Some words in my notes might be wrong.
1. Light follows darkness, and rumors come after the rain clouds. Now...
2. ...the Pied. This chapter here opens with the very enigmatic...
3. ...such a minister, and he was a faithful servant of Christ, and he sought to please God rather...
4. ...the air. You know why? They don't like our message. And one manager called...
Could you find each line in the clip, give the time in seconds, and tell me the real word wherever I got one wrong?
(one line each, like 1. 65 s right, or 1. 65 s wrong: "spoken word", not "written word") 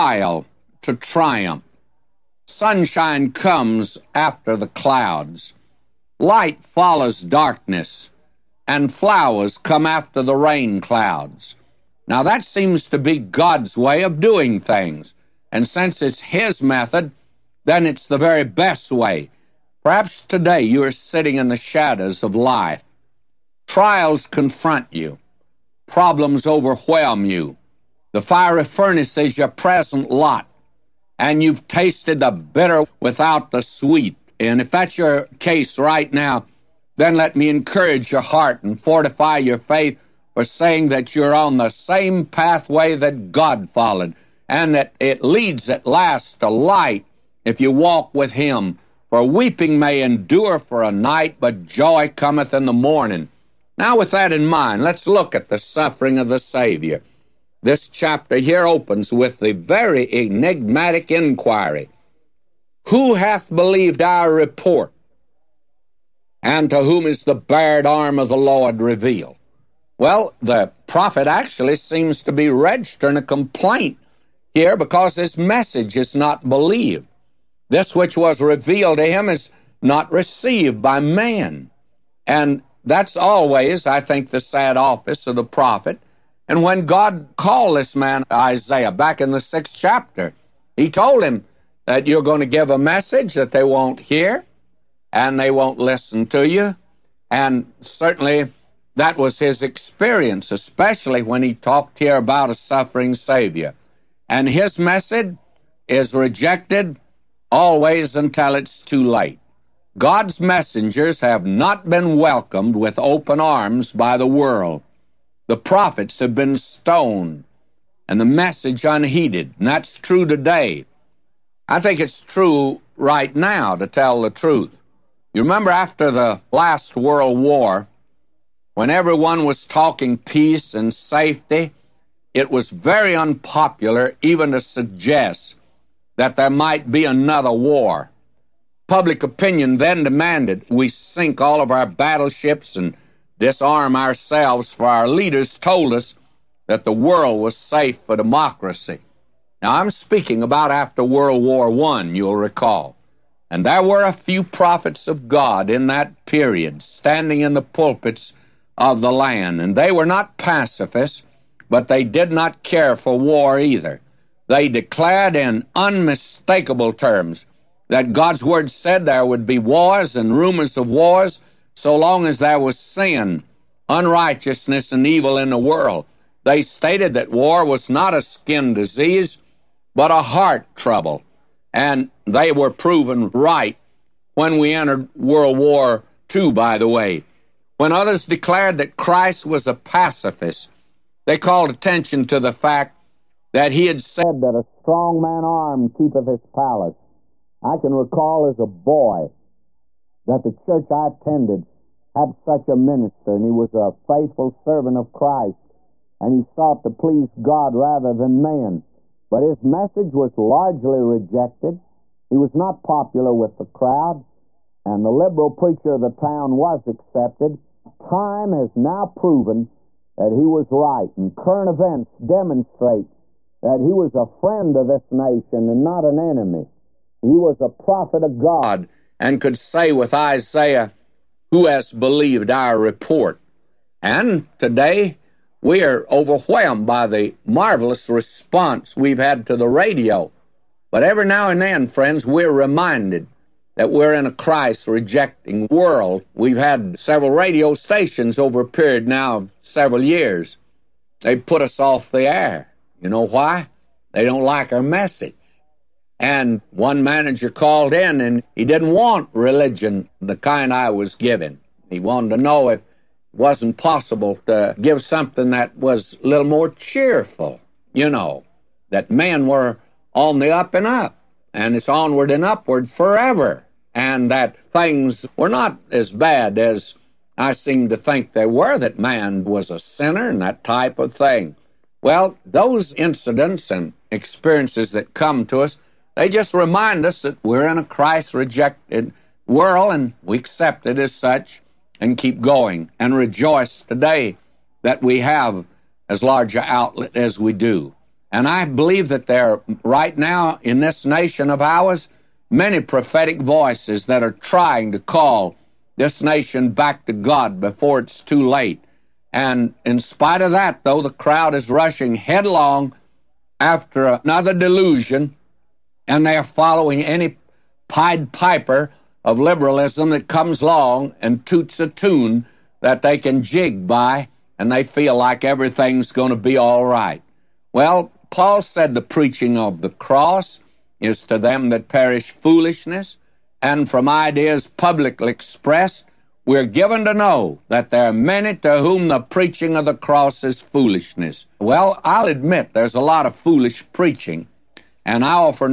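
1. 6 s wrong: "flowers", not "rumors"
2. 56 s wrong: "Savior", not "Pied"
3. 202 s right
4. 252 s right.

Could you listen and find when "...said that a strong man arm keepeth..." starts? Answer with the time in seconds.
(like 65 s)
194 s.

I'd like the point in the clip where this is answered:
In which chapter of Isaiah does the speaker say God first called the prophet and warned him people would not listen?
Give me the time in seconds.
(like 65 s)
89 s.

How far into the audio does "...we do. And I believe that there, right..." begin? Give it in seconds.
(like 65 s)
297 s.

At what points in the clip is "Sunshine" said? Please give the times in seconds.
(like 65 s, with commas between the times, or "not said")
2 s.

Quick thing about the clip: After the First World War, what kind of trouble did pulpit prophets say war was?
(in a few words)
heart trouble.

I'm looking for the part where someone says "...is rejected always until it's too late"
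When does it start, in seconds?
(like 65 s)
105 s.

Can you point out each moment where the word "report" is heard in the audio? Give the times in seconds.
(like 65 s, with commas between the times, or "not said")
64 s, 232 s.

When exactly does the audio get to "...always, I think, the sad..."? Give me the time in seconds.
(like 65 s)
83 s.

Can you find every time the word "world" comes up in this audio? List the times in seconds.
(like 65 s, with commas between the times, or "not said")
114 s, 126 s, 146 s, 151 s, 175 s, 185 s, 245 s, 289 s.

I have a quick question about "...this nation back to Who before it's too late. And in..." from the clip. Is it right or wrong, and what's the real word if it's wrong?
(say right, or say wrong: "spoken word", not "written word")
wrong: "God", not "Who".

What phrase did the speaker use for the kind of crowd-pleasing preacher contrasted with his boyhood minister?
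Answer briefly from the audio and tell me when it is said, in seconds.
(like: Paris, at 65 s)
liberal preacher, at 215 s.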